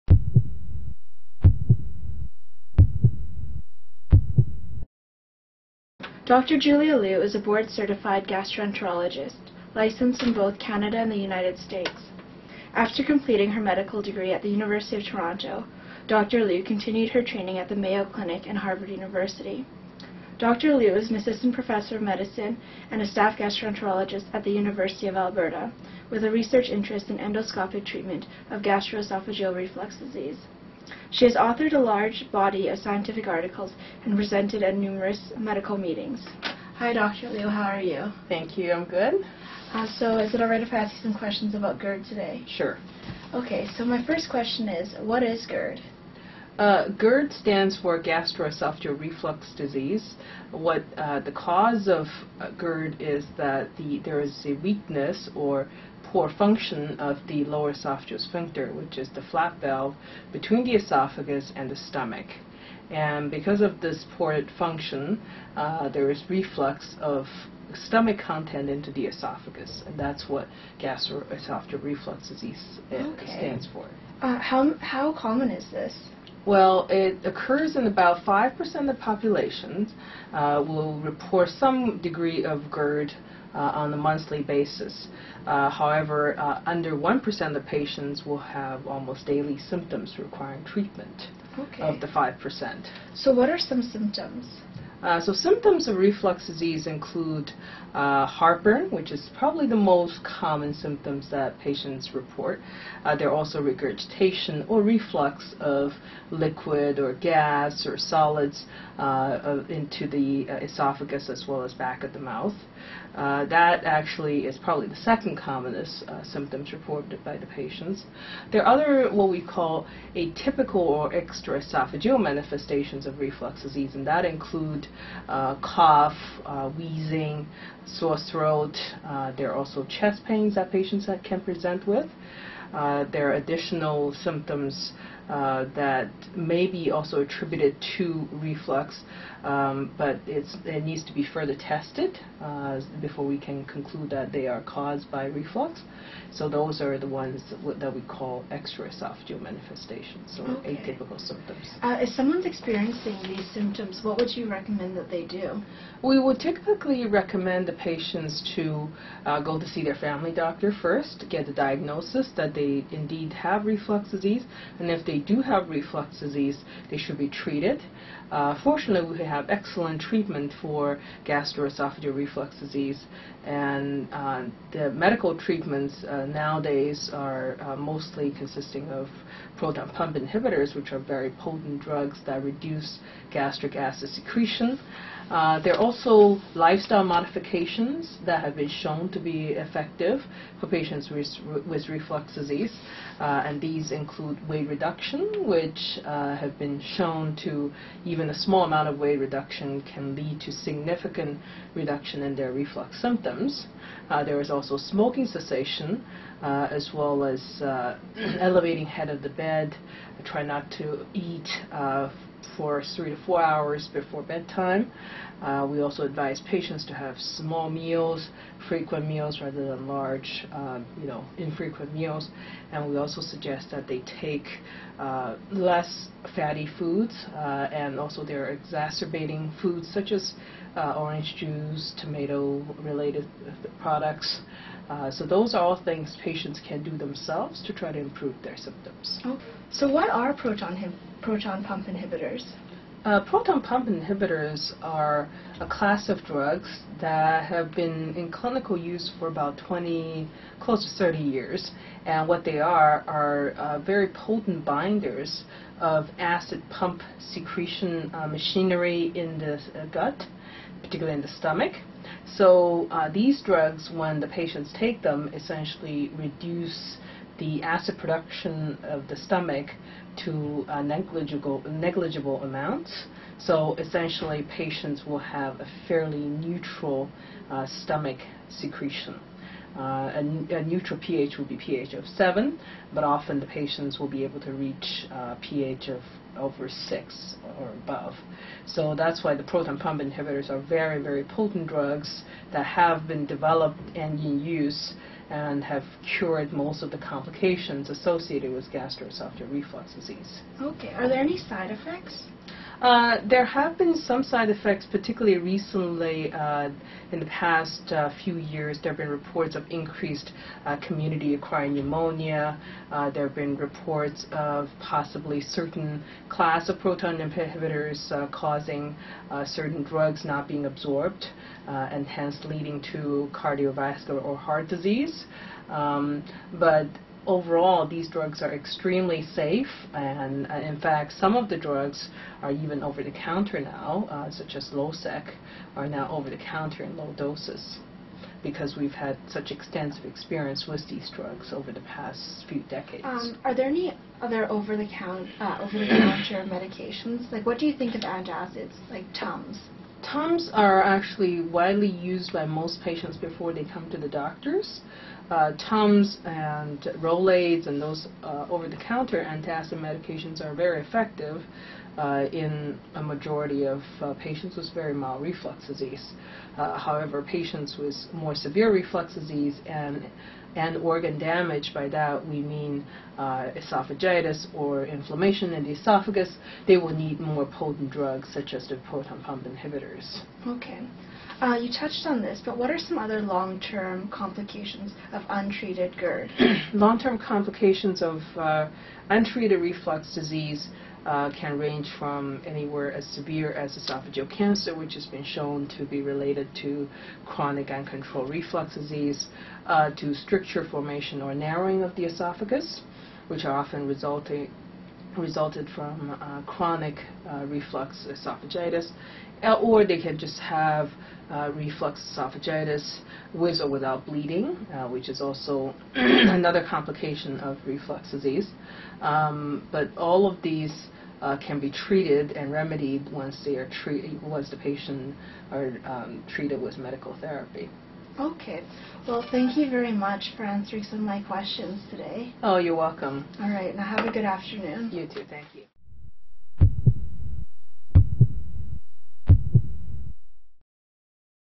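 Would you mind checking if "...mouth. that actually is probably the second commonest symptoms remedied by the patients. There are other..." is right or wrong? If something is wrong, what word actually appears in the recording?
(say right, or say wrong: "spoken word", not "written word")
wrong: "reported", not "remedied".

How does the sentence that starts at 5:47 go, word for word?
Like, what do you think of antacids, like Tums?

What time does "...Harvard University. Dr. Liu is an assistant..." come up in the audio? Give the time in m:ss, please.
0:18.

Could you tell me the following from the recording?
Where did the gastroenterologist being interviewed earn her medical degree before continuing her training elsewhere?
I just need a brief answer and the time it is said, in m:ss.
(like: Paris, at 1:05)
University of Toronto, at 0:14.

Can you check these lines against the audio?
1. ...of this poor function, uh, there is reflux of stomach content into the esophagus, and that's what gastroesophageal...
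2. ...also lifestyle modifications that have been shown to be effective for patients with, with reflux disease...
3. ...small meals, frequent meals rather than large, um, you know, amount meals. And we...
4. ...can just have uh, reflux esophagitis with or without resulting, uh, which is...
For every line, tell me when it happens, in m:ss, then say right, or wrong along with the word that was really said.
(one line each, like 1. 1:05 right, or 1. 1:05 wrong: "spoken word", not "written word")
1. 1:03 right
2. 3:05 right
3. 3:37 wrong: "infrequent", not "amount"
4. 6:50 wrong: "bleeding", not "resulting".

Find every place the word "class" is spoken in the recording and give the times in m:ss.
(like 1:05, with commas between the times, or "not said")
4:05, 5:16.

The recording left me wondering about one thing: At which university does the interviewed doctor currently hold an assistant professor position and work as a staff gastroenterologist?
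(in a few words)
University of Alberta.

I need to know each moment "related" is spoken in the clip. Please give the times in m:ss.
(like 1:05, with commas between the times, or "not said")
3:52, 6:36.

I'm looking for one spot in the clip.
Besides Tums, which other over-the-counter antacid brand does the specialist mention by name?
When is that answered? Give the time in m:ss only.
5:56.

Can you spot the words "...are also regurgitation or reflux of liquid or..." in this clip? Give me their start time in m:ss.
1:43.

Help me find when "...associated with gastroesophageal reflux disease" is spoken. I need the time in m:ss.
4:57.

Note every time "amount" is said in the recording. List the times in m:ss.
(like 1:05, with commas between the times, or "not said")
3:18, 4:32.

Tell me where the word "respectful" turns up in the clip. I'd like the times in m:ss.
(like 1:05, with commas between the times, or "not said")
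not said.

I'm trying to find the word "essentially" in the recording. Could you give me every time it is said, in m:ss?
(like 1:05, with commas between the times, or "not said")
4:25, 4:33.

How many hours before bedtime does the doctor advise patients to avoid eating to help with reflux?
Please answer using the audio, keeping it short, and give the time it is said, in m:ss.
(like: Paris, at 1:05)
3 to 4 hours, at 3:32.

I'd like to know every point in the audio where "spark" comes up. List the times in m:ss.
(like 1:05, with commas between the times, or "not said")
not said.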